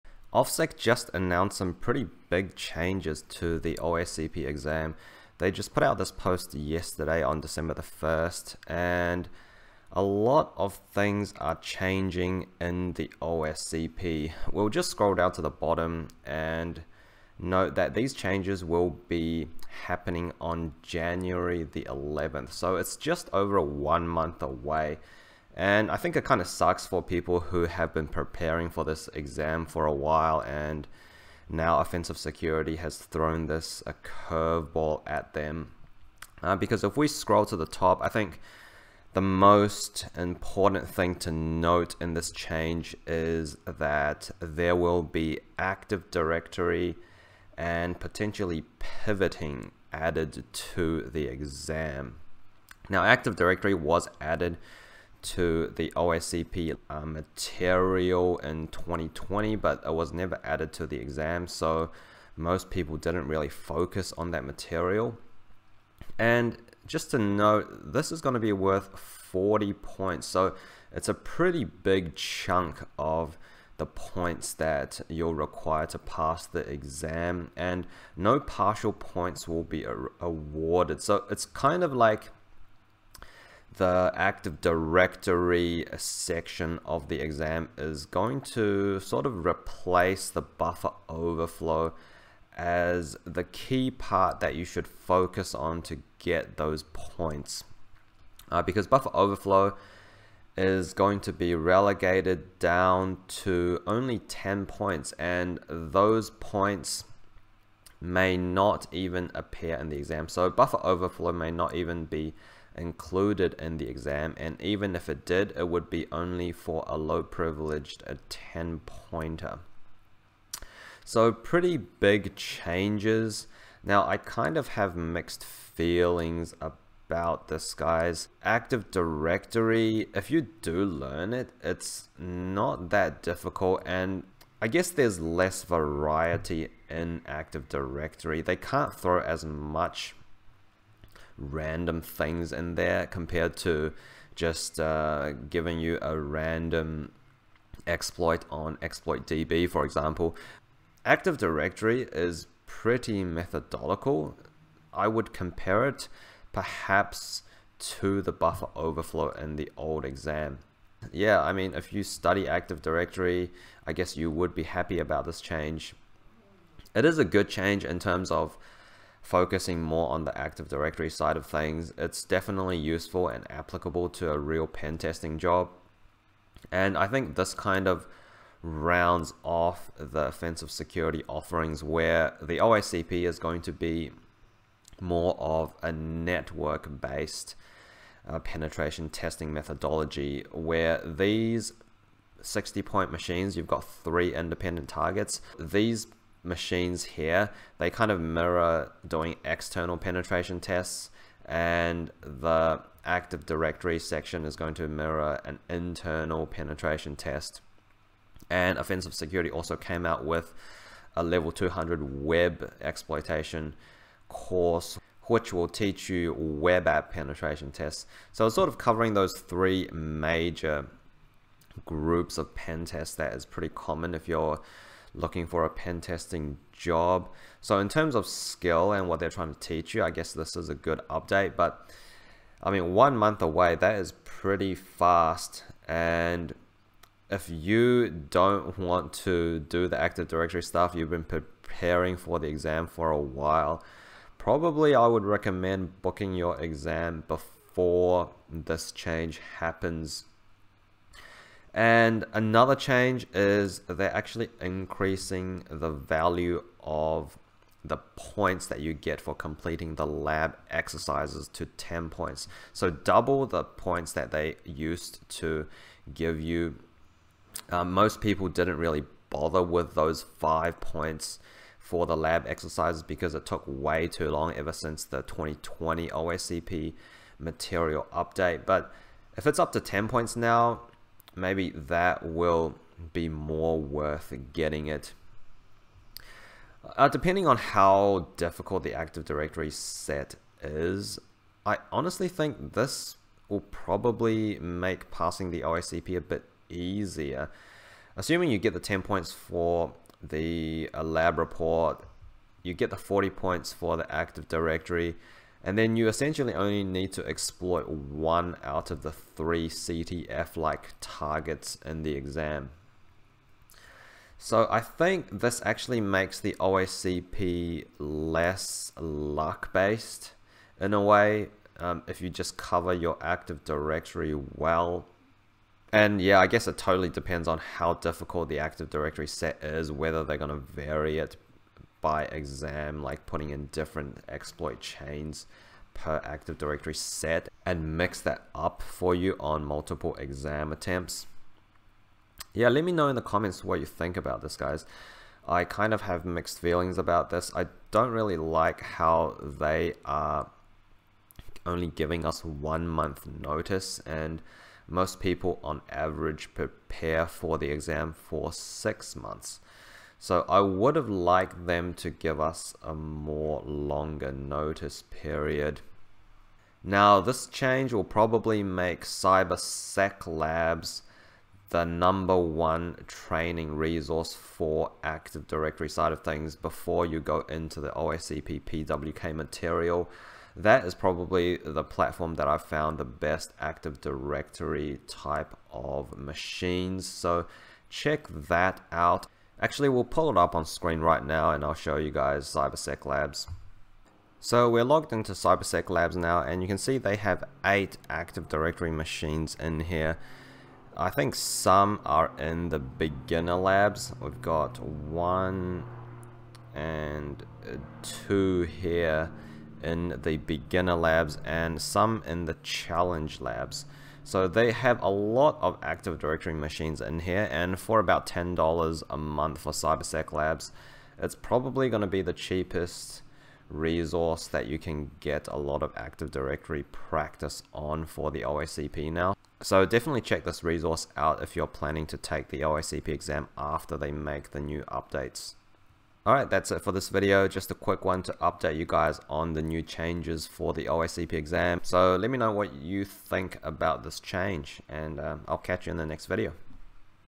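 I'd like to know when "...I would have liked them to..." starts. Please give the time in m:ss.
6:00.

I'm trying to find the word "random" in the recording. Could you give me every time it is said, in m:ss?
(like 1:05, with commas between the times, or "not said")
2:21, 2:26.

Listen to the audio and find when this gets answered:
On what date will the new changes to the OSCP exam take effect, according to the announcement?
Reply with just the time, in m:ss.
0:20.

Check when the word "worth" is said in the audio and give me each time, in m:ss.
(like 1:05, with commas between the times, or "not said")
1:08, 4:43.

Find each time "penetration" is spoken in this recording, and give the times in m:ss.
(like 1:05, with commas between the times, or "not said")
3:08, 3:19, 3:26, 3:37.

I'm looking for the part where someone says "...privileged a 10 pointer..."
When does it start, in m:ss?
1:57.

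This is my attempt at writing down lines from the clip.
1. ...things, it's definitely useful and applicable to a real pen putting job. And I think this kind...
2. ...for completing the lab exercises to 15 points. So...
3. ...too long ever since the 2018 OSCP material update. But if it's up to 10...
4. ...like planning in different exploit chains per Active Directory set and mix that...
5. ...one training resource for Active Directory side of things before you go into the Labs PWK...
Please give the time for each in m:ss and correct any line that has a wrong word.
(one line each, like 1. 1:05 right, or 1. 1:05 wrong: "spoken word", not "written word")
1. 2:51 wrong: "testing", not "putting"
2. 4:19 wrong: "10", not "15"
3. 4:34 wrong: "2020", not "2018"
4. 5:33 wrong: "putting", not "planning"
5. 6:12 wrong: "OSCP", not "Labs".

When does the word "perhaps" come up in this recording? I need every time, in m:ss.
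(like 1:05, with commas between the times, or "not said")
2:36.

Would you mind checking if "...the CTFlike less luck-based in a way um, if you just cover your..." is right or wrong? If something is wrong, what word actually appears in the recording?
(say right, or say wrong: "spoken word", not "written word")
wrong: "OSCP", not "CTFlike".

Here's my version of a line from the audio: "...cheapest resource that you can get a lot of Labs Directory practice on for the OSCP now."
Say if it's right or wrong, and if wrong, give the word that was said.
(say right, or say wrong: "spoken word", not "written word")
wrong: "Active", not "Labs".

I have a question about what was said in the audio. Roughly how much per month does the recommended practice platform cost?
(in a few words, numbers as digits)
$10.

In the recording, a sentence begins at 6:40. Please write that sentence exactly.
I think some are in the beginner labs.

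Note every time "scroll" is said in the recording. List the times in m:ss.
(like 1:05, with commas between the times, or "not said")
0:14, 0:37.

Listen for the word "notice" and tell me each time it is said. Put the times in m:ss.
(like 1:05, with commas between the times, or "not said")
5:53, 6:04.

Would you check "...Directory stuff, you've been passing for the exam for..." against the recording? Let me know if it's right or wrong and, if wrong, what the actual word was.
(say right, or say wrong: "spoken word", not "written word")
wrong: "preparing", not "passing".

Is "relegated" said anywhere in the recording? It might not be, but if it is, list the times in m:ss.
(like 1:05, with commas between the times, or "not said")
1:41.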